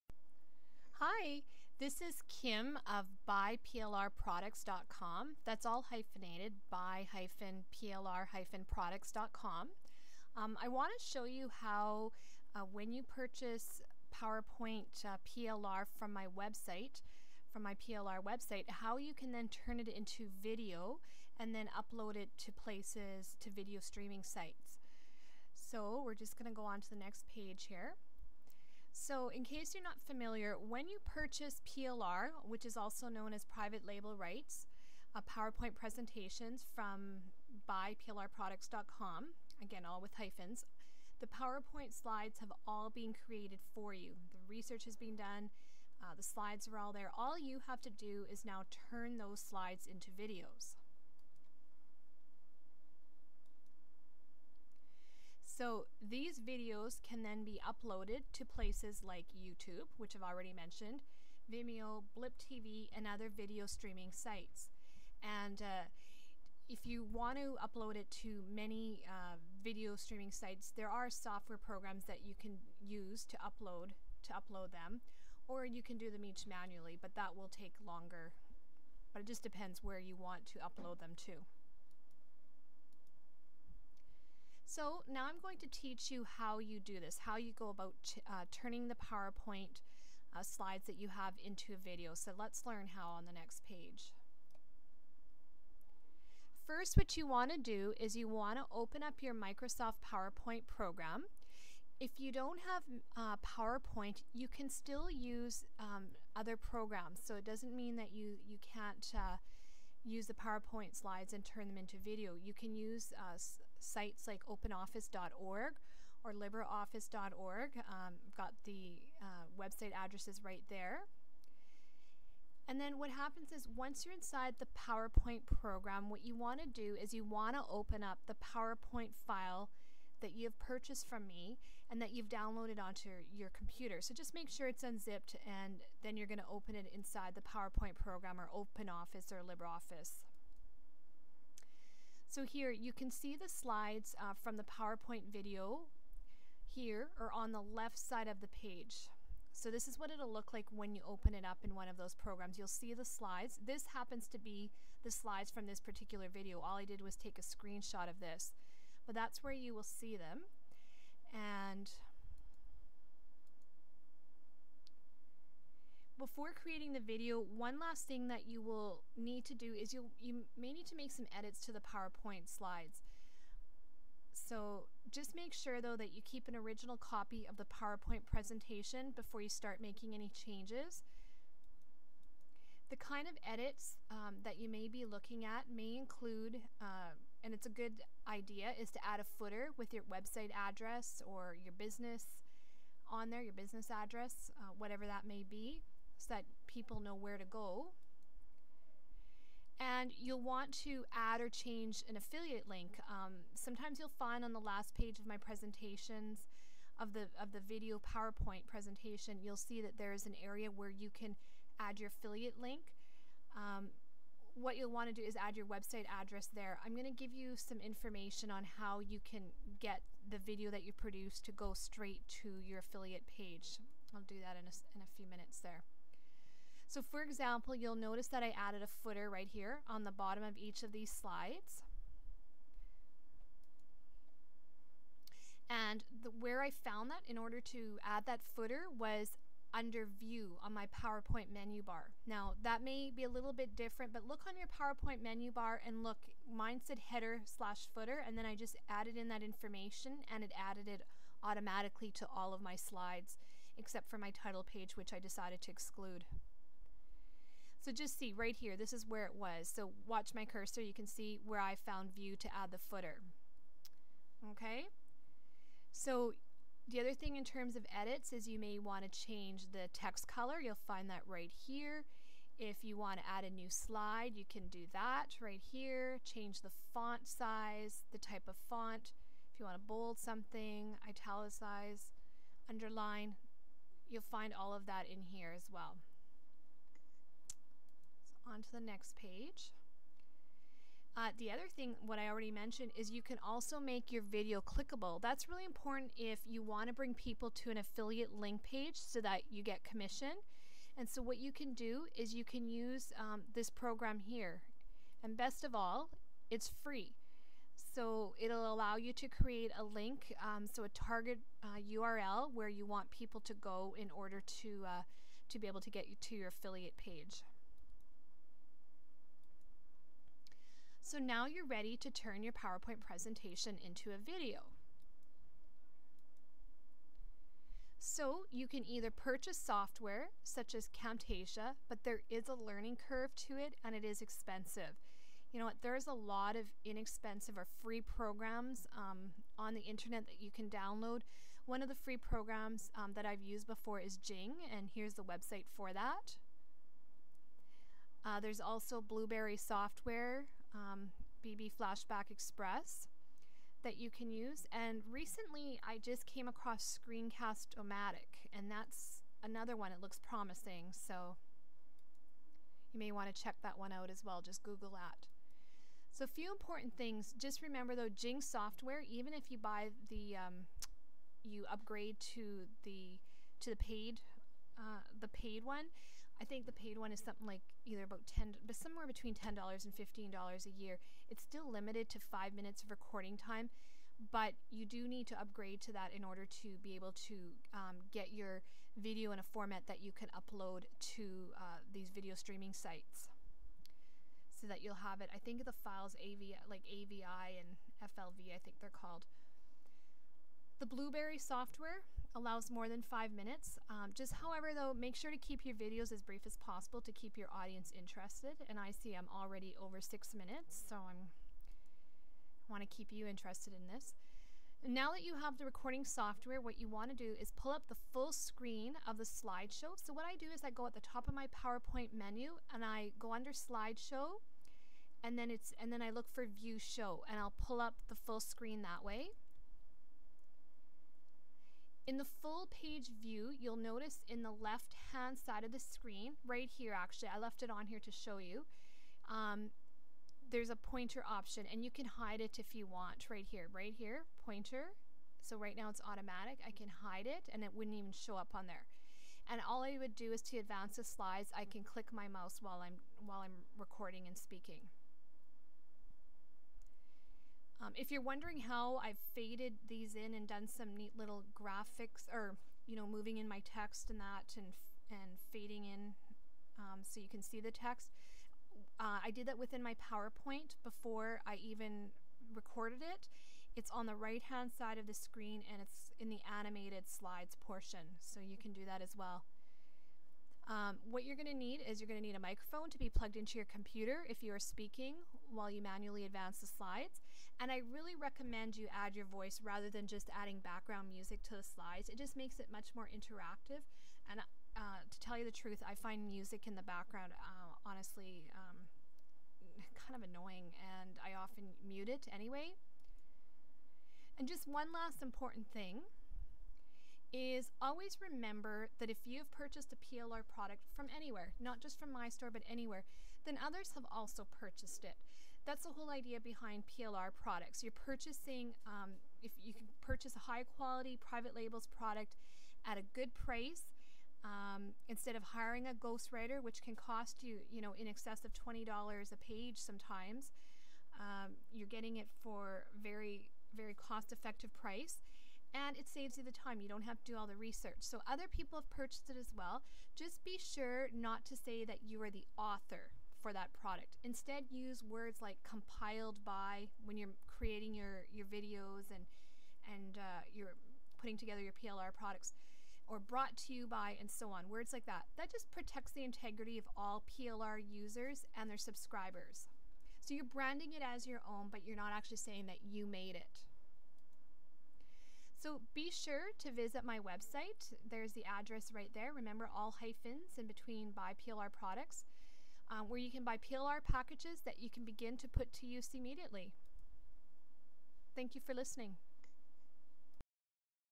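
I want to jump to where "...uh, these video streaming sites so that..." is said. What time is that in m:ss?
6:31.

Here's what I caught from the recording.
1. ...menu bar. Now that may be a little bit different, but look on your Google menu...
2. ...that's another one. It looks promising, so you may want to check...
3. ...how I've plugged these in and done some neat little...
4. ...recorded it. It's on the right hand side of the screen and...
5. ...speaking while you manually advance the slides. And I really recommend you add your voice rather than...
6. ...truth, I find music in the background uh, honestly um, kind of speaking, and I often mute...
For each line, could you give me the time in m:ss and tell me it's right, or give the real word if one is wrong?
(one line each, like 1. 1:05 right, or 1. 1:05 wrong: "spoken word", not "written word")
1. 4:01 wrong: "PowerPoint", not "Google"
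2. 5:58 right
3. 7:38 wrong: "faded", not "plugged"
4. 7:52 right
5. 8:04 right
6. 8:15 wrong: "annoying", not "speaking".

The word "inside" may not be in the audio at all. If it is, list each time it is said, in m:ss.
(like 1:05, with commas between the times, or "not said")
2:04, 2:16.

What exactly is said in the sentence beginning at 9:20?
So you're branding it as your own, but you're not actually saying that you made it.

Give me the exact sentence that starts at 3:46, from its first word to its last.
So for example, you'll notice that I added a footer right here on the bottom of each of these slides.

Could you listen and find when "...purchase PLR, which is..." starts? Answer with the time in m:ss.
0:31.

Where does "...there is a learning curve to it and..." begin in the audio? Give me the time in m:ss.
5:32.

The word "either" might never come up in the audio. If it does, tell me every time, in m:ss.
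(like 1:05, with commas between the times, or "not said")
5:28, 6:17.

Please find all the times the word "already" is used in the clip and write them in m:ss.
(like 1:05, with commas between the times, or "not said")
1:00, 4:52, 6:49.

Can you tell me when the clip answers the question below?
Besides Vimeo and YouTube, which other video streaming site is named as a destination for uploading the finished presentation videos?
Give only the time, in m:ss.
1:02.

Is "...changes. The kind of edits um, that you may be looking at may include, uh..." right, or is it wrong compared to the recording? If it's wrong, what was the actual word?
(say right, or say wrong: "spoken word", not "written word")
right.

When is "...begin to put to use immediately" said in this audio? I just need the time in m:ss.
9:35.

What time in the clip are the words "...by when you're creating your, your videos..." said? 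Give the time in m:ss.
9:06.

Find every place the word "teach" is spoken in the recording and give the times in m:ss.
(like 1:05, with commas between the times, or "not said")
1:25.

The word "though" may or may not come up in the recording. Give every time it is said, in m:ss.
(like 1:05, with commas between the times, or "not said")
2:55, 6:07, 6:44.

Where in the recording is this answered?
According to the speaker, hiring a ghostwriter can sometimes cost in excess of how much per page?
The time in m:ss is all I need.
8:48.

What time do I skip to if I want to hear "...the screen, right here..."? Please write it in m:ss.
7:15.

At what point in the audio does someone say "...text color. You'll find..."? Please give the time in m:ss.
4:29.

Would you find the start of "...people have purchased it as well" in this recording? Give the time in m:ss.
8:58.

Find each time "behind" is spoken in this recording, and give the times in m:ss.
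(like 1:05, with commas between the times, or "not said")
8:36.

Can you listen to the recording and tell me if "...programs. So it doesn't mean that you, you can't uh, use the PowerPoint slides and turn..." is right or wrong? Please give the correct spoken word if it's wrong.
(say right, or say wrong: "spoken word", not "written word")
right.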